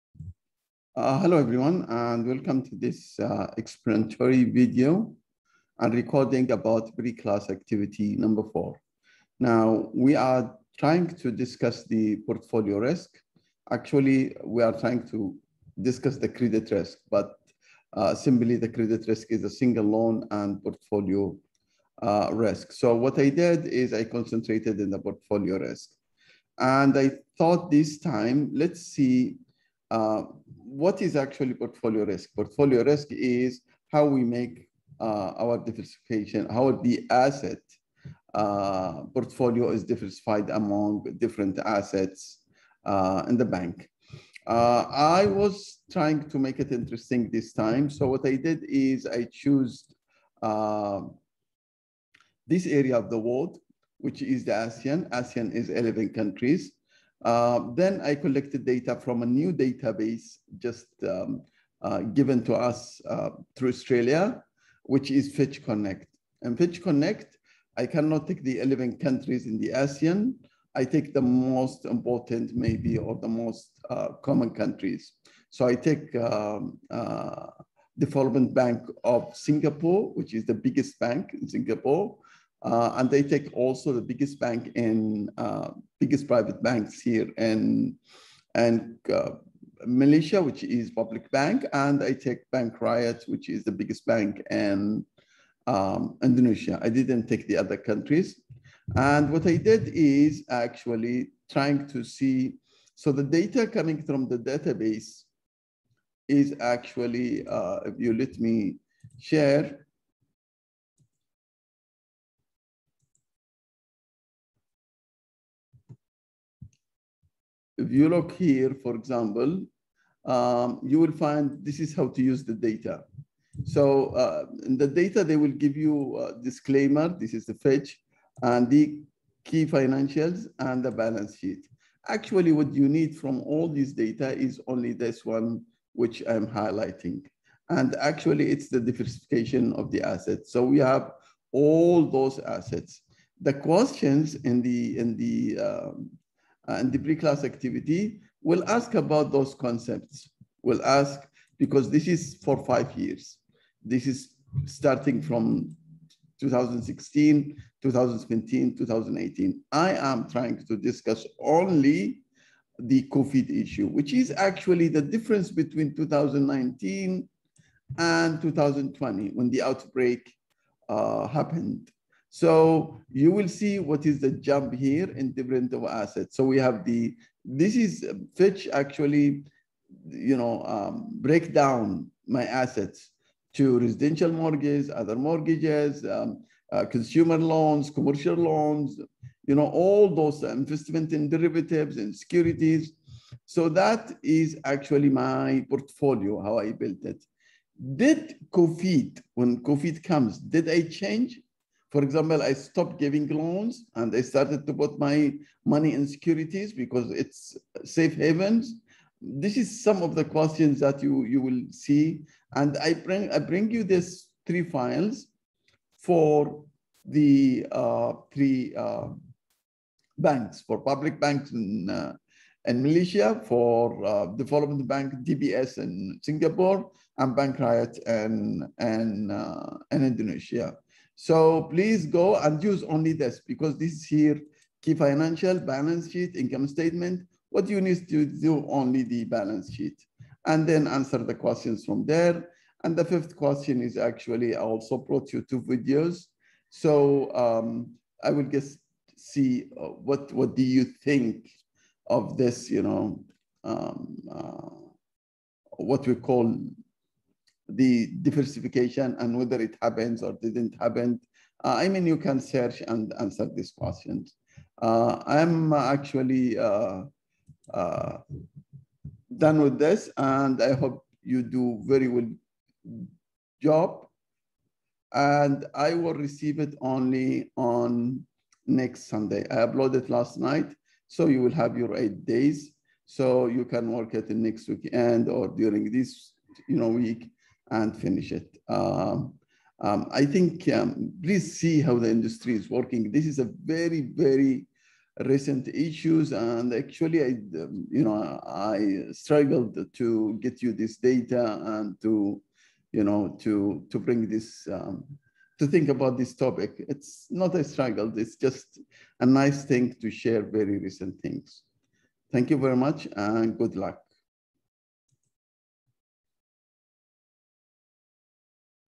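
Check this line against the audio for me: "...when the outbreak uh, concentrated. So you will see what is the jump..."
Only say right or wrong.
wrong.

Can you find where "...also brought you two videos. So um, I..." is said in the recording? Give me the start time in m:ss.
4:04.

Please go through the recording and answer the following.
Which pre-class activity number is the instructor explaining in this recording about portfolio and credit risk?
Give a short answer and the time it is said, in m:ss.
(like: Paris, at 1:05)
4, at 0:08.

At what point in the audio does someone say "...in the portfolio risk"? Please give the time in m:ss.
0:24.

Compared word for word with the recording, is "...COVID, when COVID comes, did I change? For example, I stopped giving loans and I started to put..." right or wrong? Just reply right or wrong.
right.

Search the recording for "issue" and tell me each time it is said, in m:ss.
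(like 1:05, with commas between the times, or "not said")
2:43, 4:55.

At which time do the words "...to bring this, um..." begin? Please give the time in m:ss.
5:03.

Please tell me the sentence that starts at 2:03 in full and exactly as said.
So uh, in the data, they will give you a disclaimer.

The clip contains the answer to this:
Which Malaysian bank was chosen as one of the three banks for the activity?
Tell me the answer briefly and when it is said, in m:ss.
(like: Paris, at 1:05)
Public Bank, at 1:30.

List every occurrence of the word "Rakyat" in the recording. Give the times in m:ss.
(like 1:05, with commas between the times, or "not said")
1:32, 3:47.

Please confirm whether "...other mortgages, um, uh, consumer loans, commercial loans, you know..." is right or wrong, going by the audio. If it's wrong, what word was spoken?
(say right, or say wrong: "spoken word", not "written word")
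right.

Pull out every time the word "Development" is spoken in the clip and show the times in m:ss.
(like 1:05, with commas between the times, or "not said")
1:17, 3:44.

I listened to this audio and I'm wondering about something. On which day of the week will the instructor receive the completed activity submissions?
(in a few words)
Sunday.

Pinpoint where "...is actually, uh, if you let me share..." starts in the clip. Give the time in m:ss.
1:46.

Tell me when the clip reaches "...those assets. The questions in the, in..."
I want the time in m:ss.
2:22.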